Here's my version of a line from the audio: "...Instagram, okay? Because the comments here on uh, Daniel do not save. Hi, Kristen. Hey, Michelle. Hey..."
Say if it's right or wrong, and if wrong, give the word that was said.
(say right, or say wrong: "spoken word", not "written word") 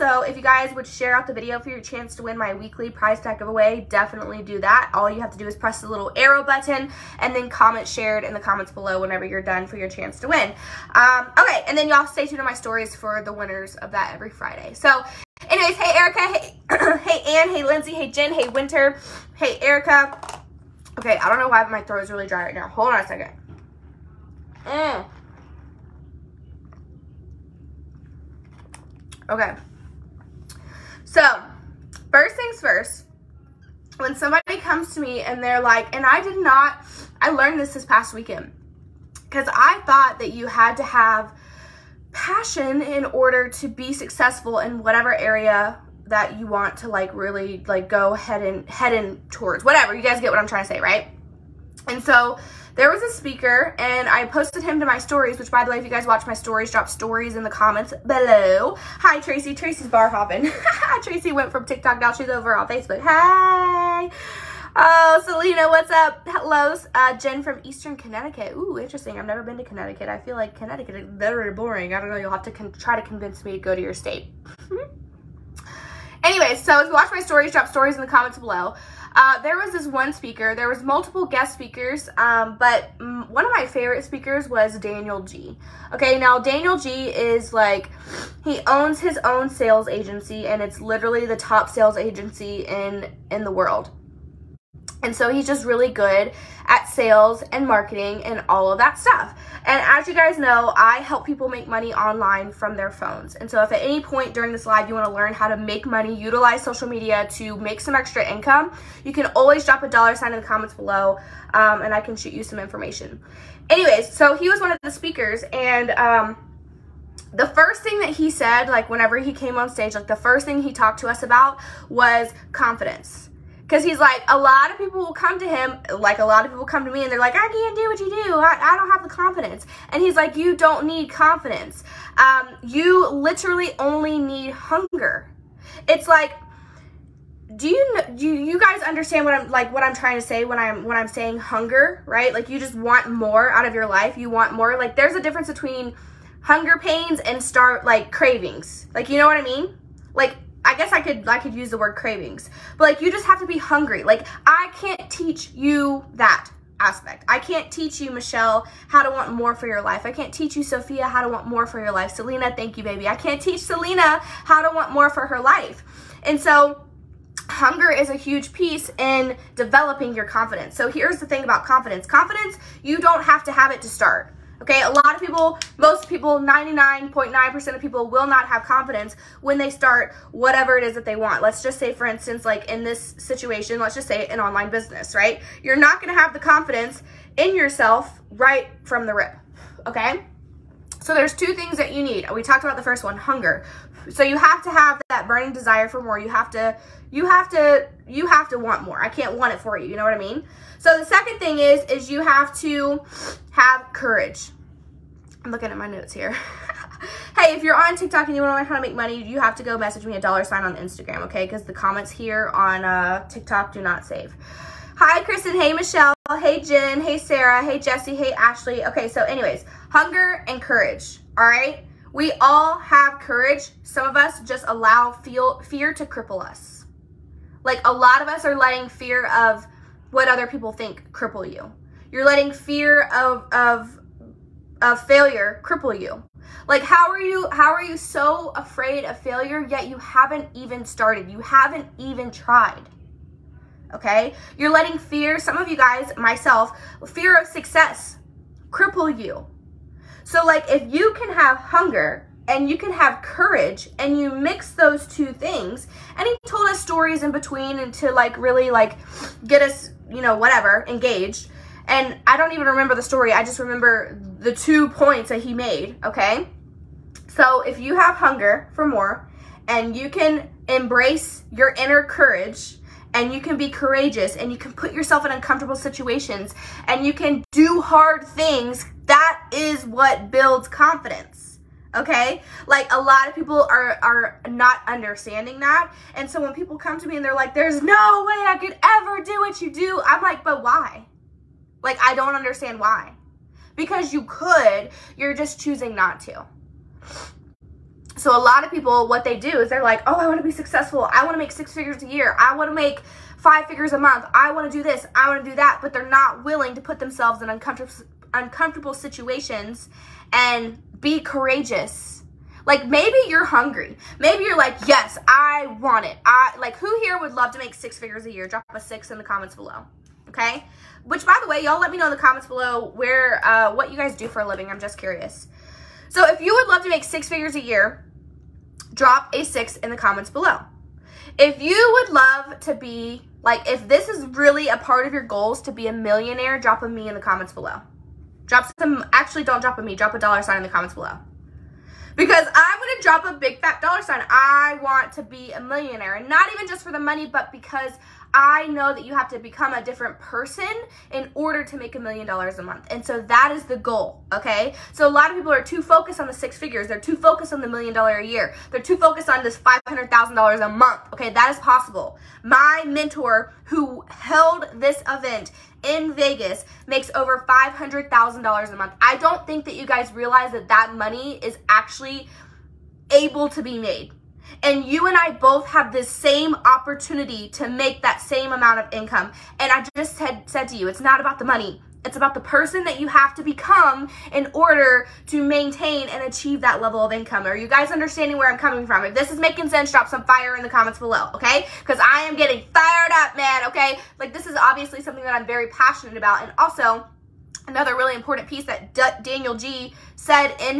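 wrong: "TikTok", not "Daniel".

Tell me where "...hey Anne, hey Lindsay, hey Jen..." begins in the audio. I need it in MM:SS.
00:17.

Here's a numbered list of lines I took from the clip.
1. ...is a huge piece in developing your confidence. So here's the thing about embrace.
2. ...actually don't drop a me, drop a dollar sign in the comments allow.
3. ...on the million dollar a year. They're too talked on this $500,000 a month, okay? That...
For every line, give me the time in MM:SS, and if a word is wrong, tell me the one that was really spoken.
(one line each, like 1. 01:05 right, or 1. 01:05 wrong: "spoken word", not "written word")
1. 02:47 wrong: "confidence", not "embrace"
2. 05:39 wrong: "below", not "allow"
3. 05:57 wrong: "focused", not "talked".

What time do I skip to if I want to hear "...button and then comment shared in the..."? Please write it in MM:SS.
00:06.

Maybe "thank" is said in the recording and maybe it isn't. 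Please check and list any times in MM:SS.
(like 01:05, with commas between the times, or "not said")
02:42.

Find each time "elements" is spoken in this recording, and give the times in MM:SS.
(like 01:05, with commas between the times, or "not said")
not said.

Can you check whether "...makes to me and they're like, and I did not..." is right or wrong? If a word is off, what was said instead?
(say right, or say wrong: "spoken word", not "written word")
wrong: "comes", not "makes".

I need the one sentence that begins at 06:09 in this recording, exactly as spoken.
I don't think that you guys realize that that money is actually able to be made.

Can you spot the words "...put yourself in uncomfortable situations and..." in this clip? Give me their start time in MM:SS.
04:34.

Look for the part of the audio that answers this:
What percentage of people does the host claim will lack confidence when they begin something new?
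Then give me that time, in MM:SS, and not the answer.
02:56.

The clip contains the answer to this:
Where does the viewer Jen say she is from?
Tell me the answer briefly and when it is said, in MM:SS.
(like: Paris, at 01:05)
Eastern Connecticut, at 01:07.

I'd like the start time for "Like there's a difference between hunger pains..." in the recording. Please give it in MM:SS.
02:24.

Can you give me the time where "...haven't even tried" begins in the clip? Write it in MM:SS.
04:01.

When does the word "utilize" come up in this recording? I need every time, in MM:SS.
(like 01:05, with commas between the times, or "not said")
01:46.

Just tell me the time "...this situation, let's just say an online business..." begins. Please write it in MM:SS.
03:02.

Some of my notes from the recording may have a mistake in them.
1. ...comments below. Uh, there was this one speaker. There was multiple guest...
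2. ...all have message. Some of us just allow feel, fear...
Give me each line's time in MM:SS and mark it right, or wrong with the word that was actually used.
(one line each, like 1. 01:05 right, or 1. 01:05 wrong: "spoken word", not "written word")
1. 01:18 right
2. 03:42 wrong: "courage", not "message".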